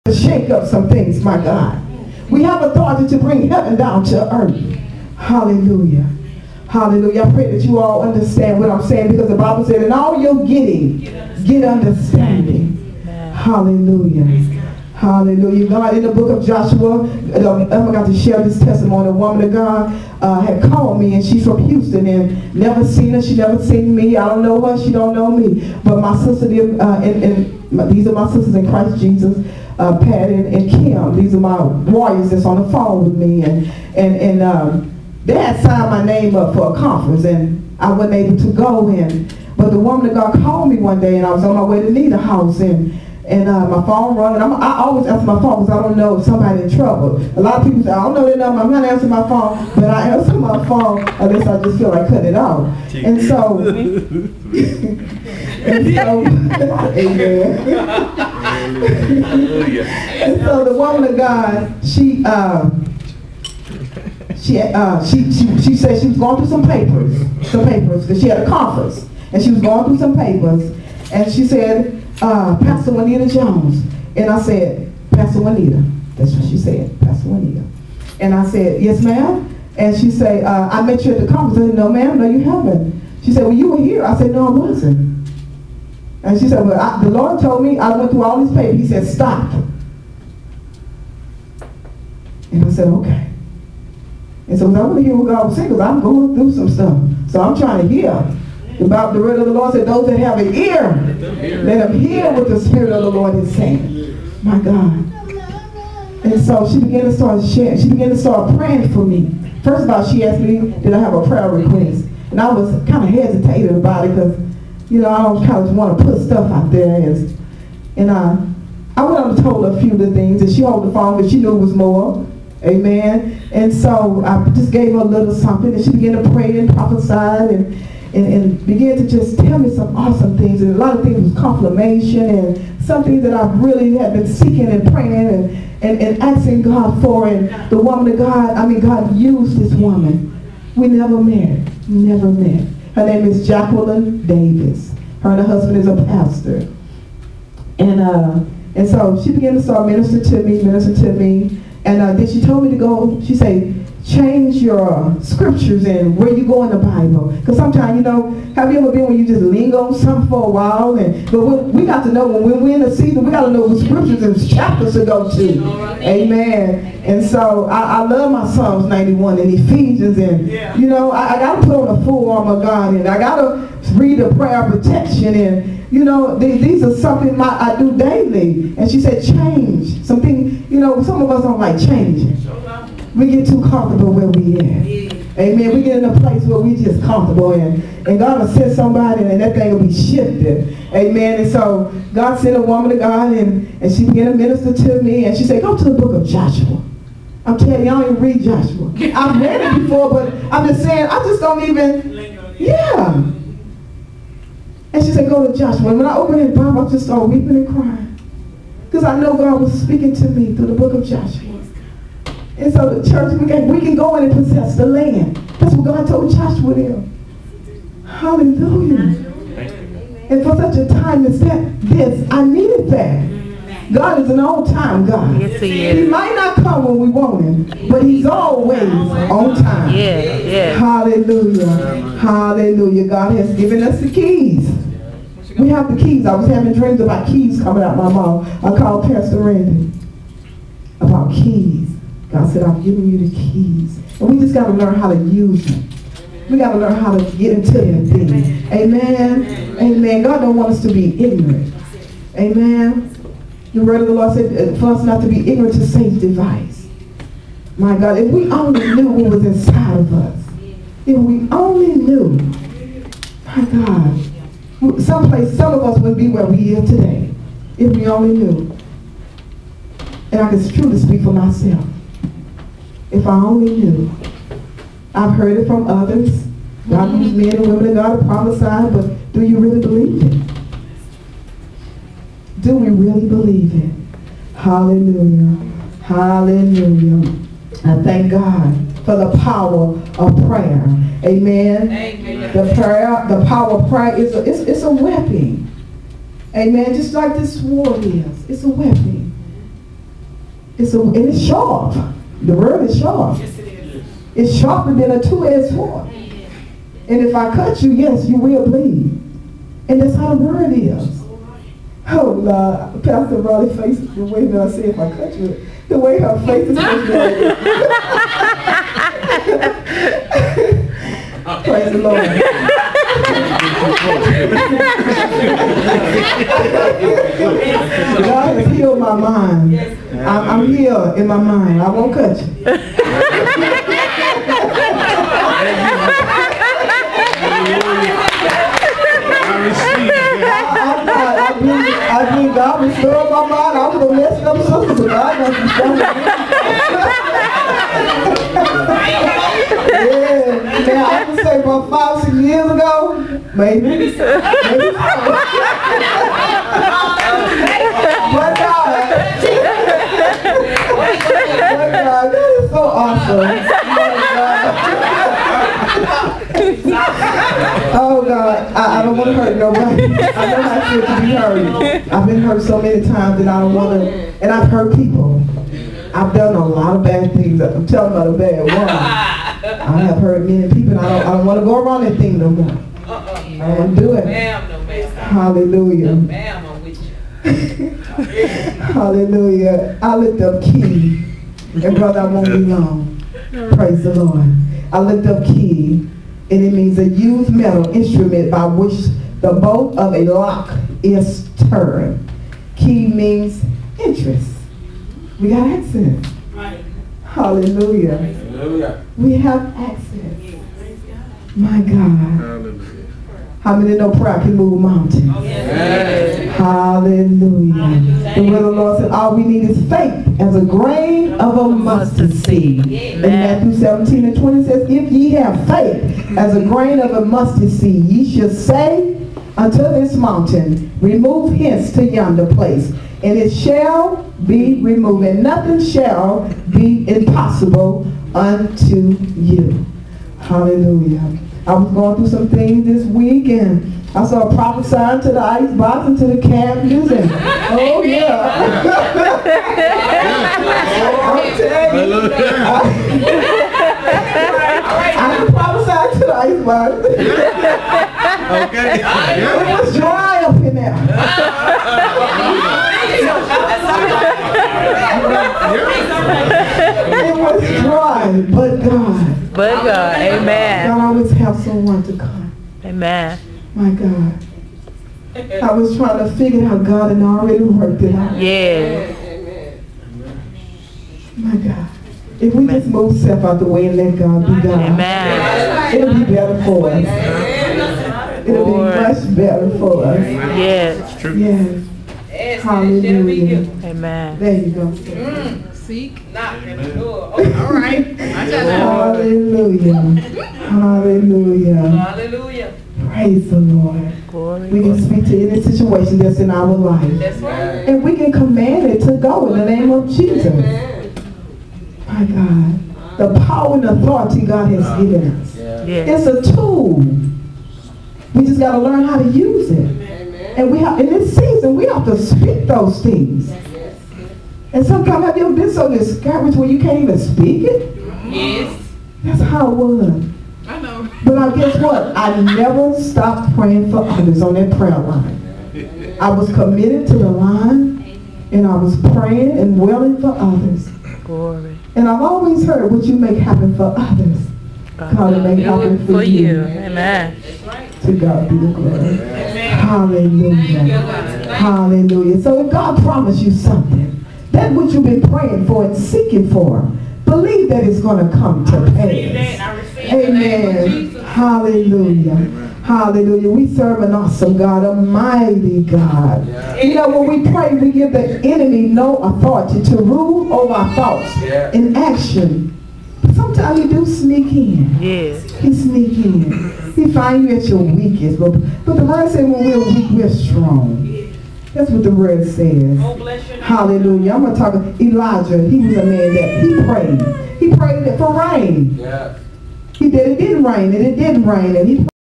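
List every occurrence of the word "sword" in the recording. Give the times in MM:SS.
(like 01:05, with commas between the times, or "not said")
04:57, 05:05.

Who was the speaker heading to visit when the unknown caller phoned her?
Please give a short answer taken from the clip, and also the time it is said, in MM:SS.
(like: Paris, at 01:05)
Nita, at 00:41.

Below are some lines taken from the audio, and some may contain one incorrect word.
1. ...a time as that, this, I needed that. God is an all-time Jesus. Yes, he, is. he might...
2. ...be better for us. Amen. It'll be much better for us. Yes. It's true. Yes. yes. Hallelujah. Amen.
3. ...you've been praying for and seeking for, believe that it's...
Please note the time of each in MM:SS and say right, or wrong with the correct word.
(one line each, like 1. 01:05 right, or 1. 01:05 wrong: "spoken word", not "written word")
1. 03:40 wrong: "God", not "Jesus"
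2. 08:06 right
3. 09:14 right.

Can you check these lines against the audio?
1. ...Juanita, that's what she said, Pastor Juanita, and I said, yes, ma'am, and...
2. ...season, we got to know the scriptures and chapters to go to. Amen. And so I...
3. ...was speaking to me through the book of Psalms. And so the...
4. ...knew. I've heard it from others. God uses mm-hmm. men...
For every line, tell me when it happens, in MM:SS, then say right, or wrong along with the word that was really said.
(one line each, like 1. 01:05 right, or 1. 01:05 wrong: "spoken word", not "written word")
1. 01:15 right
2. 02:42 right
3. 03:29 wrong: "Joshua", not "Psalms"
4. 04:33 right.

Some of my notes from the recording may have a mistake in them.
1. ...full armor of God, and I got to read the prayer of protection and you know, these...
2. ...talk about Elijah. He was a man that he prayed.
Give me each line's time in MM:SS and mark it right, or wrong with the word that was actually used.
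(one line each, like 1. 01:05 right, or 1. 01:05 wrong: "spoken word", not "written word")
1. 02:52 right
2. 09:44 right.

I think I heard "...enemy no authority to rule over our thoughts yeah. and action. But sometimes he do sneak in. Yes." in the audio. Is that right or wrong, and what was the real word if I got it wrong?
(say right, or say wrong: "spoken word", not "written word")
right.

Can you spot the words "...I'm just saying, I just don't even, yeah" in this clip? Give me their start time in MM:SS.
03:20.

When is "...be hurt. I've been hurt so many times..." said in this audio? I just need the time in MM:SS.
06:11.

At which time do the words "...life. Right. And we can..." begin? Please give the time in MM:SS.
08:26.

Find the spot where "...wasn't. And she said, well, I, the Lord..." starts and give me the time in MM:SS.
01:24.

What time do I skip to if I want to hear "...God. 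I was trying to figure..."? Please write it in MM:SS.
07:53.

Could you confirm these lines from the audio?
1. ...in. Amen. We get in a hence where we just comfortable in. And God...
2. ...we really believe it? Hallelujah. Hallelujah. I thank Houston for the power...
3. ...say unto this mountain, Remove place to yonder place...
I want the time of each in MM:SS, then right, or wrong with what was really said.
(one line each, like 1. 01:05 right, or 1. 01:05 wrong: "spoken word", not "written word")
1. 03:04 wrong: "place", not "hence"
2. 04:42 wrong: "God", not "Houston"
3. 07:08 wrong: "hence", not "place".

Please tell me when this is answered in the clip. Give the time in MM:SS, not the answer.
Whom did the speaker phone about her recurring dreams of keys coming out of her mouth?
03:59.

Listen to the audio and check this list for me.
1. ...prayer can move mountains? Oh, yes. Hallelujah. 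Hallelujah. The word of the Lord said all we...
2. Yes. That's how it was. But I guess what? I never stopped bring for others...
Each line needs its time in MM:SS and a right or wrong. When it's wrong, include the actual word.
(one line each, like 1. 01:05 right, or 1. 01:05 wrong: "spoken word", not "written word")
1. 06:54 right
2. 08:48 wrong: "praying", not "bring".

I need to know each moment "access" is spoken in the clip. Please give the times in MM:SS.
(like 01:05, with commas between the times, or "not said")
06:45, 06:49.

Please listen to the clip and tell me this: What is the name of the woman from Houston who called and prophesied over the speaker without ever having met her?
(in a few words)
Jacqueline Davis.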